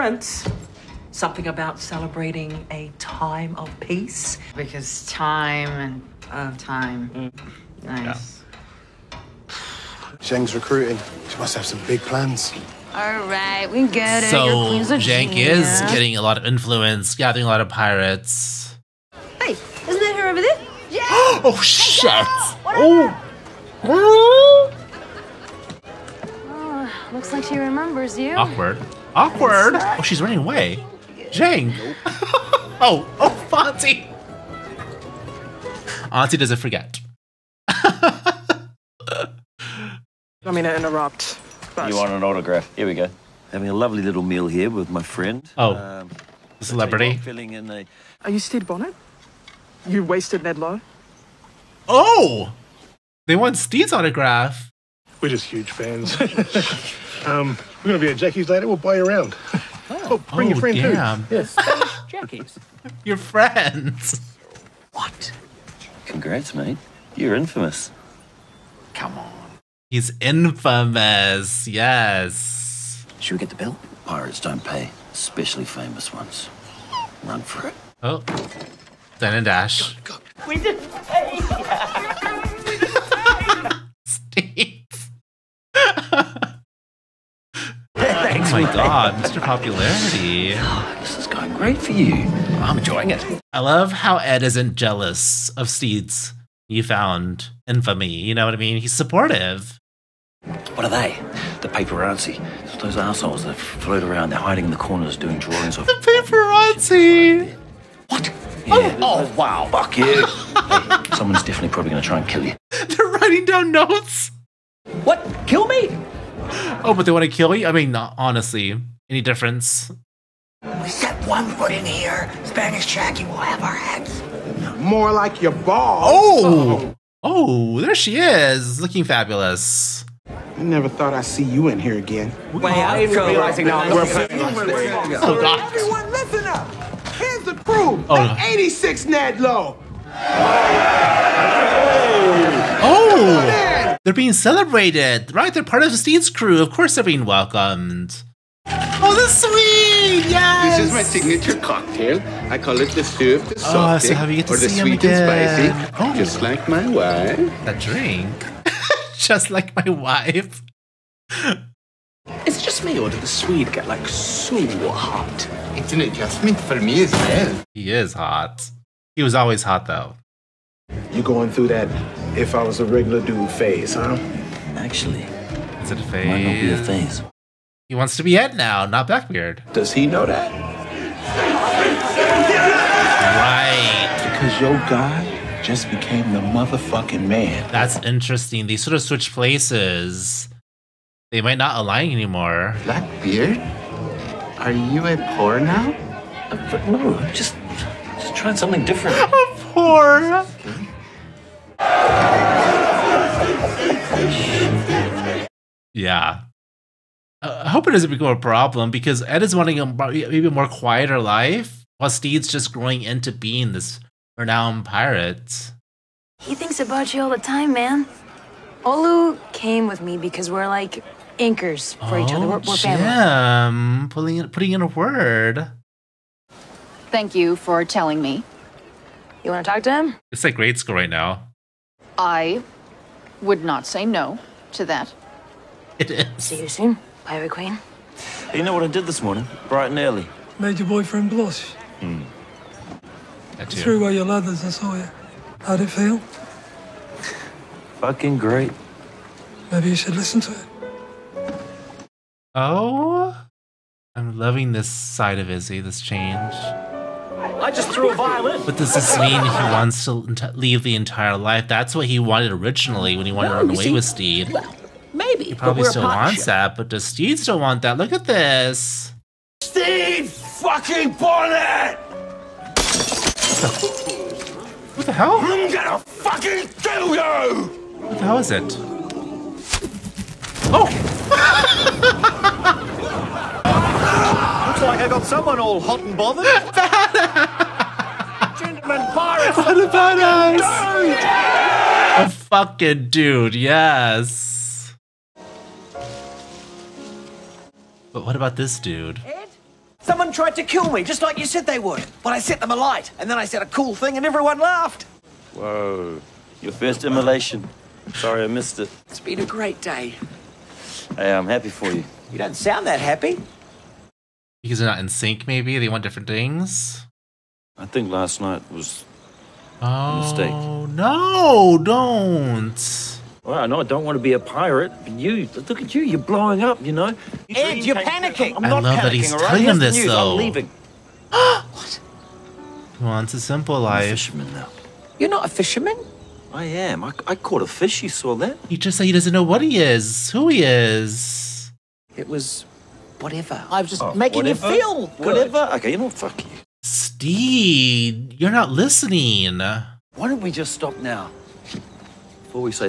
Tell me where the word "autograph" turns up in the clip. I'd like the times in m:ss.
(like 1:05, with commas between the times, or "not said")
0:42, 0:53.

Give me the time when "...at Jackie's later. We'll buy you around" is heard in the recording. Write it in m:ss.
0:58.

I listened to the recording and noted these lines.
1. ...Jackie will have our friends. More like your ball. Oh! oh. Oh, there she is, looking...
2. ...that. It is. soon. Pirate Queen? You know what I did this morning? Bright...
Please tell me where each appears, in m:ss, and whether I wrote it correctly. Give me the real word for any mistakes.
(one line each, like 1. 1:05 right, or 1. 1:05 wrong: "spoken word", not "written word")
1. 2:02 wrong: "heads", not "friends"
2. 3:54 right.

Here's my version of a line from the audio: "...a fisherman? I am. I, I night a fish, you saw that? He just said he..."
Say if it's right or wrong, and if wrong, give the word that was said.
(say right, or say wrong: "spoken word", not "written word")
wrong: "caught", not "night".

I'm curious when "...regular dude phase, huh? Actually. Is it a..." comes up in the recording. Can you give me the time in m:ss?
2:52.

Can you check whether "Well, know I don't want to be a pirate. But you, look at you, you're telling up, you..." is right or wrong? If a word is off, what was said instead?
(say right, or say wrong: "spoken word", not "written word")
wrong: "blowing", not "telling".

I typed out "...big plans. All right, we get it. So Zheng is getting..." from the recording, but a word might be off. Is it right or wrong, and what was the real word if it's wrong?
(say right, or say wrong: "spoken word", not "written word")
right.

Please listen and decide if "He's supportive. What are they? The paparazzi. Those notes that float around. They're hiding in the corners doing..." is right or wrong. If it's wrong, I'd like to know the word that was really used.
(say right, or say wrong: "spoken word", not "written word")
wrong: "assholes", not "notes".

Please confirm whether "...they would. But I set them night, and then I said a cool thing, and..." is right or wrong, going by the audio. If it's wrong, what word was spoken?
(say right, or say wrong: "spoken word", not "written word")
wrong: "alight", not "night".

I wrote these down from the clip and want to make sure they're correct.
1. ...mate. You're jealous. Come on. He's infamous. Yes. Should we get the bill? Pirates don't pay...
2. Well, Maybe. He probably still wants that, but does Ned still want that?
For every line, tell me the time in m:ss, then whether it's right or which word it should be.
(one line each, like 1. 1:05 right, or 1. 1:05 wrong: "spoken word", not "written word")
1. 1:06 wrong: "infamous", not "jealous"
2. 4:24 wrong: "Stede", not "Ned".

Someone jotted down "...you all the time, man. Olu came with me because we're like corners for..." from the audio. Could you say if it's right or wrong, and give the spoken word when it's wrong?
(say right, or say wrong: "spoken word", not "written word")
wrong: "anchors", not "corners".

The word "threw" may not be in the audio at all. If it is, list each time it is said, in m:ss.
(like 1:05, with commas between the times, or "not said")
4:03, 4:17.